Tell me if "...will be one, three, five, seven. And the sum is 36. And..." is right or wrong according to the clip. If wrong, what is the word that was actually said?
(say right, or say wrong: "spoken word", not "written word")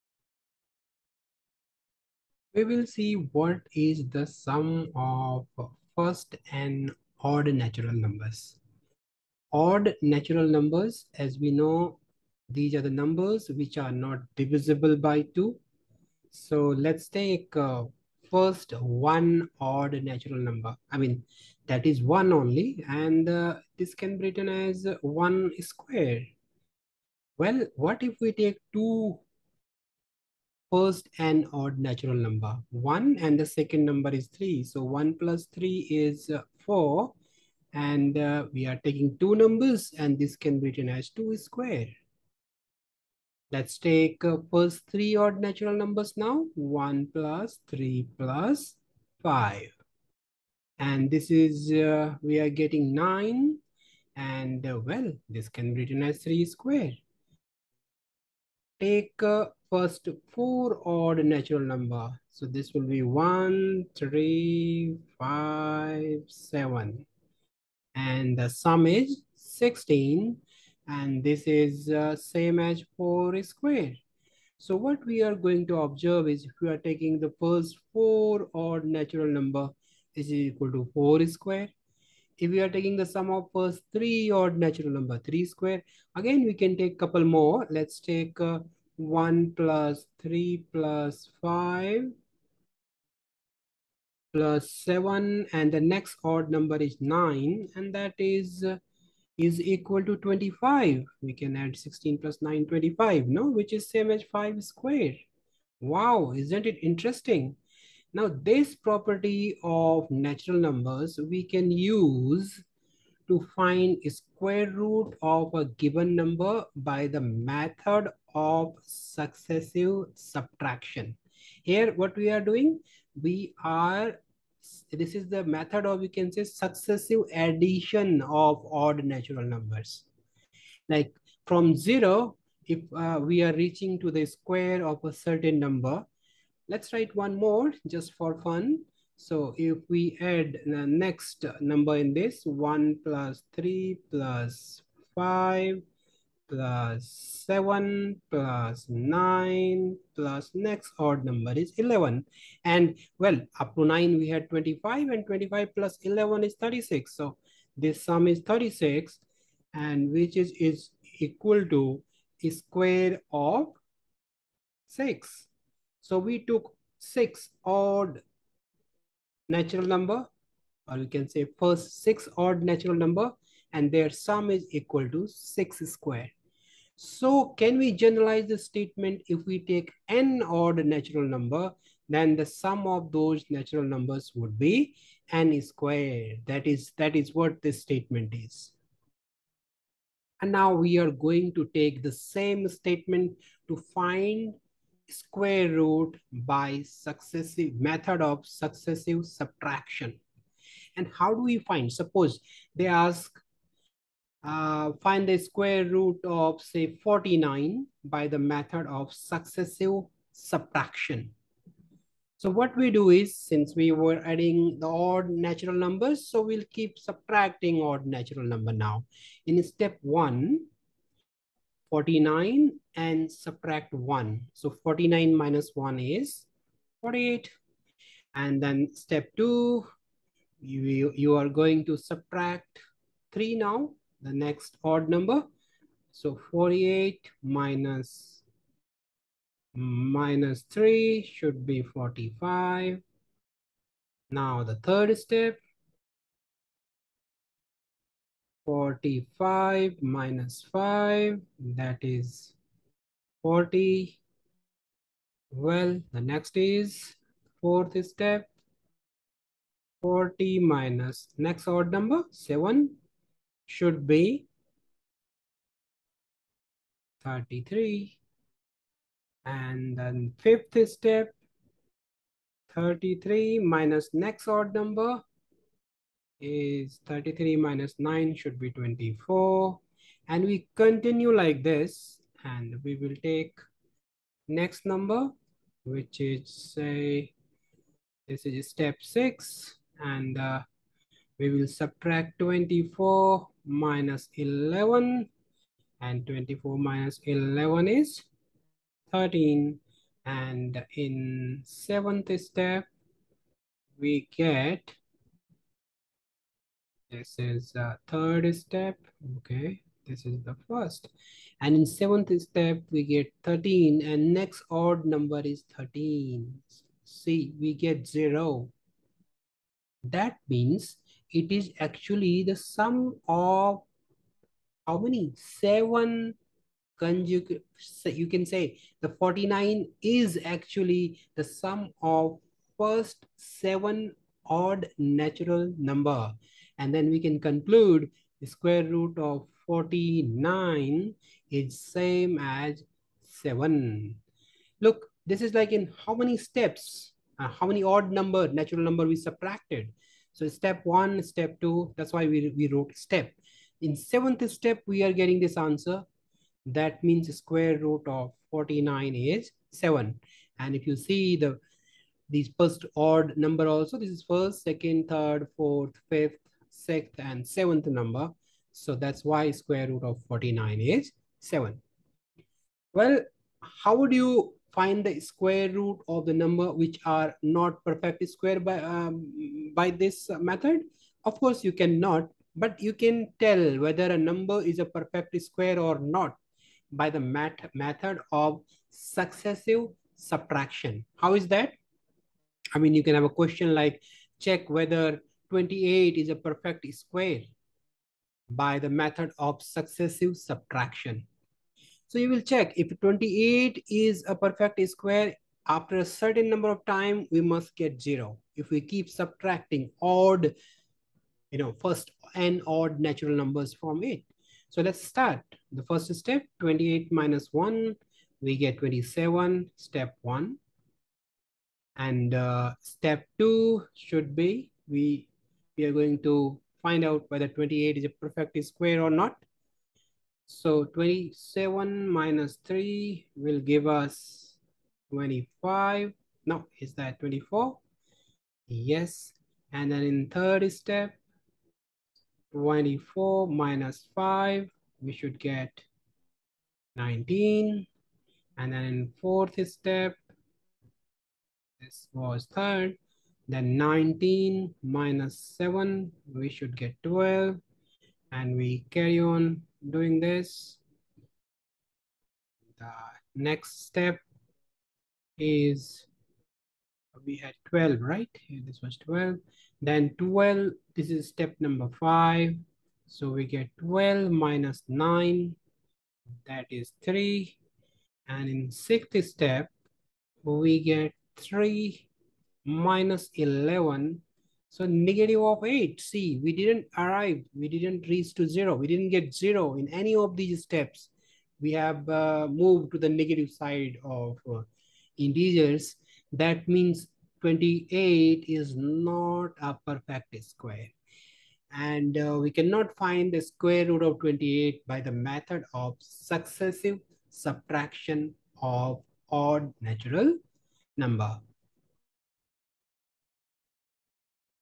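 wrong: "16", not "36".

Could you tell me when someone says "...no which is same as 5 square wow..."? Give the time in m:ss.
1:43.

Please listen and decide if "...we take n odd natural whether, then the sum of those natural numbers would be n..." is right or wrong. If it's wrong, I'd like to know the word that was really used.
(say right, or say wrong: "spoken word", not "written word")
wrong: "number", not "whether".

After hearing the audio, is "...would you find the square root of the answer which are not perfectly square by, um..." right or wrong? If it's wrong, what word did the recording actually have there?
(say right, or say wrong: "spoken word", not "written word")
wrong: "number", not "answer".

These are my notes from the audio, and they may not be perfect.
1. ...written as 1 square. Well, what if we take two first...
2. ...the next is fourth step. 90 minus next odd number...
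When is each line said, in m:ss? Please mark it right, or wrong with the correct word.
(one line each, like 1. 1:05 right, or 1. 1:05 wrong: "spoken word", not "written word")
1. 0:24 right
2. 4:16 wrong: "40", not "90".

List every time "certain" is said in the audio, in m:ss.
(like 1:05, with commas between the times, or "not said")
2:15, 6:46.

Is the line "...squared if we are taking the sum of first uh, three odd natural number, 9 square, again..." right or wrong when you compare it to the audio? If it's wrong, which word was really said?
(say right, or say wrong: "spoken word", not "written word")
wrong: "3", not "9".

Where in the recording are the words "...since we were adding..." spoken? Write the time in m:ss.
3:33.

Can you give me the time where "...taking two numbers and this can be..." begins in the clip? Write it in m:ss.
0:38.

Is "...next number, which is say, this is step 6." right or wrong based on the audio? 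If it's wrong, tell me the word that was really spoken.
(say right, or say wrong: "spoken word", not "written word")
right.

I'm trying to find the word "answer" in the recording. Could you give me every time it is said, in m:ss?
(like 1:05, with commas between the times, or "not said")
5:55.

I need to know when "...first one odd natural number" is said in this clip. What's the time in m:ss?
0:18.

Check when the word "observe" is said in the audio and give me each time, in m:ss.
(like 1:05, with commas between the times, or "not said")
1:15.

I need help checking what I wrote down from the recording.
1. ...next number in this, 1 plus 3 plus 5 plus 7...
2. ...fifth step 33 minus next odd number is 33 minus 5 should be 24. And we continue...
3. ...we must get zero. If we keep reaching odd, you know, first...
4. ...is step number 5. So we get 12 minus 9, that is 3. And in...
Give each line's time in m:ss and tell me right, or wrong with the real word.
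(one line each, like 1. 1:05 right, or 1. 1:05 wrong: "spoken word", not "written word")
1. 2:20 right
2. 4:30 wrong: "9", not "5"
3. 6:47 wrong: "subtracting", not "reaching"
4. 7:51 right.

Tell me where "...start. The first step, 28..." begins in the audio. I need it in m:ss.
6:55.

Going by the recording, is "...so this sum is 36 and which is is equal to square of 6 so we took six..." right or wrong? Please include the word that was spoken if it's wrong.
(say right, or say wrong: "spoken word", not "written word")
right.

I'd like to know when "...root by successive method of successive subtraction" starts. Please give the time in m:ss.
3:15.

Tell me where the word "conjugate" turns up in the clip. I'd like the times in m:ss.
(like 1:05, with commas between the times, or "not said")
5:26.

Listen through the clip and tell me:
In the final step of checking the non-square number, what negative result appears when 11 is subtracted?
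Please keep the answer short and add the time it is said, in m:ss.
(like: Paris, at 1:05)
-8, at 8:04.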